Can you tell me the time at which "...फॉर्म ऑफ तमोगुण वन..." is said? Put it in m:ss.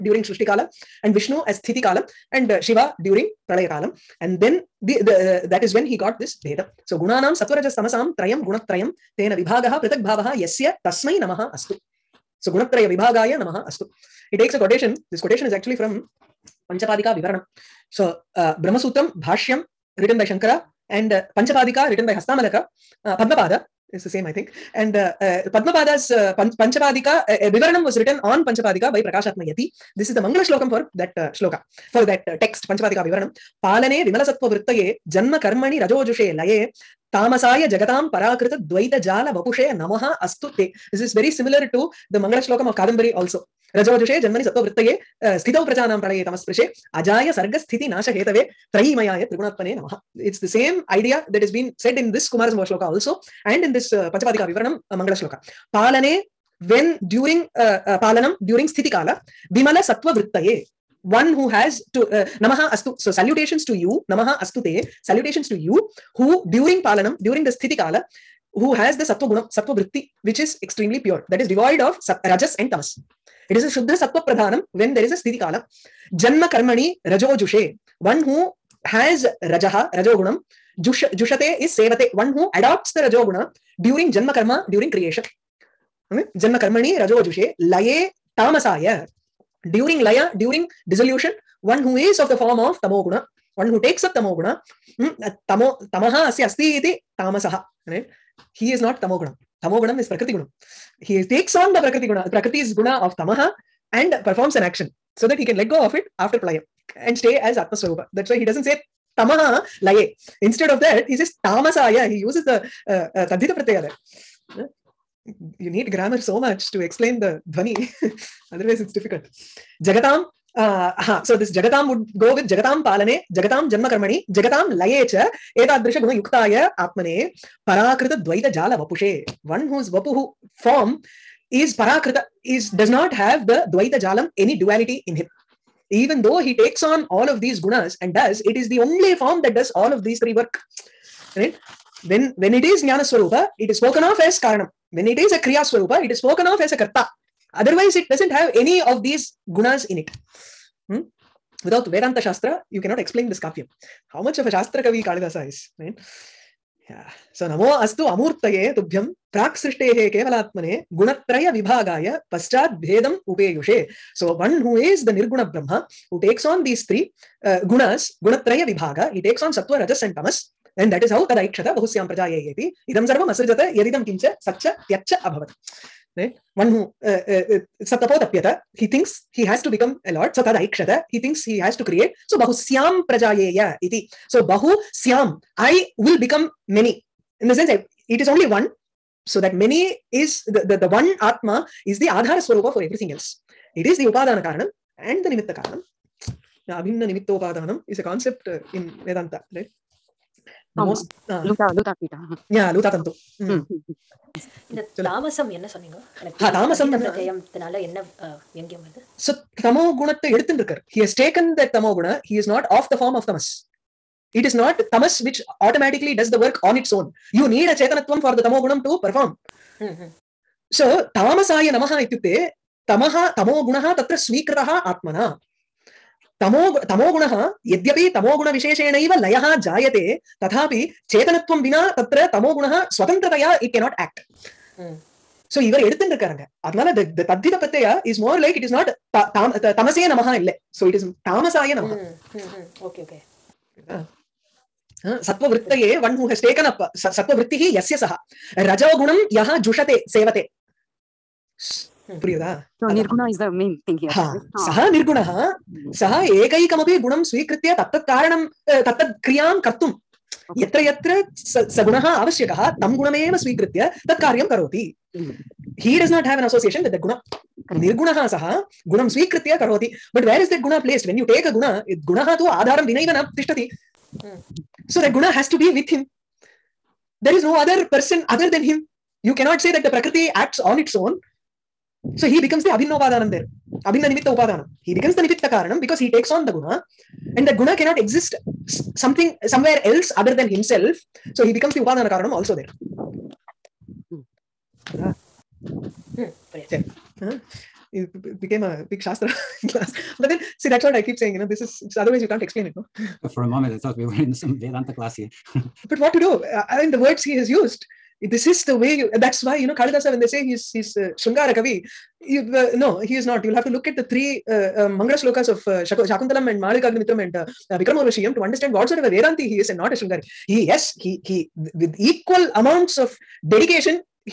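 1:32.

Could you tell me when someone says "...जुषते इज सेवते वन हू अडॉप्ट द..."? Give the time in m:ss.
1:21.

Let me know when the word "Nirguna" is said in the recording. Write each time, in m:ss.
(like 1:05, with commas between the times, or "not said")
2:45.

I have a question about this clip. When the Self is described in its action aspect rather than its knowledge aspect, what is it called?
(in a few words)
Karta.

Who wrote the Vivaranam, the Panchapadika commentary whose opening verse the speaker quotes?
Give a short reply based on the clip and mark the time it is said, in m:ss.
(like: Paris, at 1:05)
Prakashatmayati, at 0:29.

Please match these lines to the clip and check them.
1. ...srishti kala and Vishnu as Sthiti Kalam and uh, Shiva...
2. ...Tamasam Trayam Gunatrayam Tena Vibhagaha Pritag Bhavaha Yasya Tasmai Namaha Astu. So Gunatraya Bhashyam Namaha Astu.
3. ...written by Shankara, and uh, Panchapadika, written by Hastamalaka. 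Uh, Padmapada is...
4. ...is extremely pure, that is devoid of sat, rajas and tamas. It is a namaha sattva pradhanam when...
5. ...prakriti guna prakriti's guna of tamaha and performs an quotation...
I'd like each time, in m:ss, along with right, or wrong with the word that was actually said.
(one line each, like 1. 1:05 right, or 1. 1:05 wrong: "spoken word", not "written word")
1. 0:00 right
2. 0:07 wrong: "Vibhagaya", not "Bhashyam"
3. 0:19 right
4. 1:10 wrong: "shuddha", not "namaha"
5. 1:41 wrong: "action", not "quotation".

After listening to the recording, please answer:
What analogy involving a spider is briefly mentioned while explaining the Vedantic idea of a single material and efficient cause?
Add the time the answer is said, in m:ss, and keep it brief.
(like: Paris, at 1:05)
Luta Tantu, at 3:22.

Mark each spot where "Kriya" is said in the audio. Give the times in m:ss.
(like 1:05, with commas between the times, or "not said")
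2:25.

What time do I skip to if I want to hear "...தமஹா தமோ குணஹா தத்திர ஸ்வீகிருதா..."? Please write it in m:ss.
3:42.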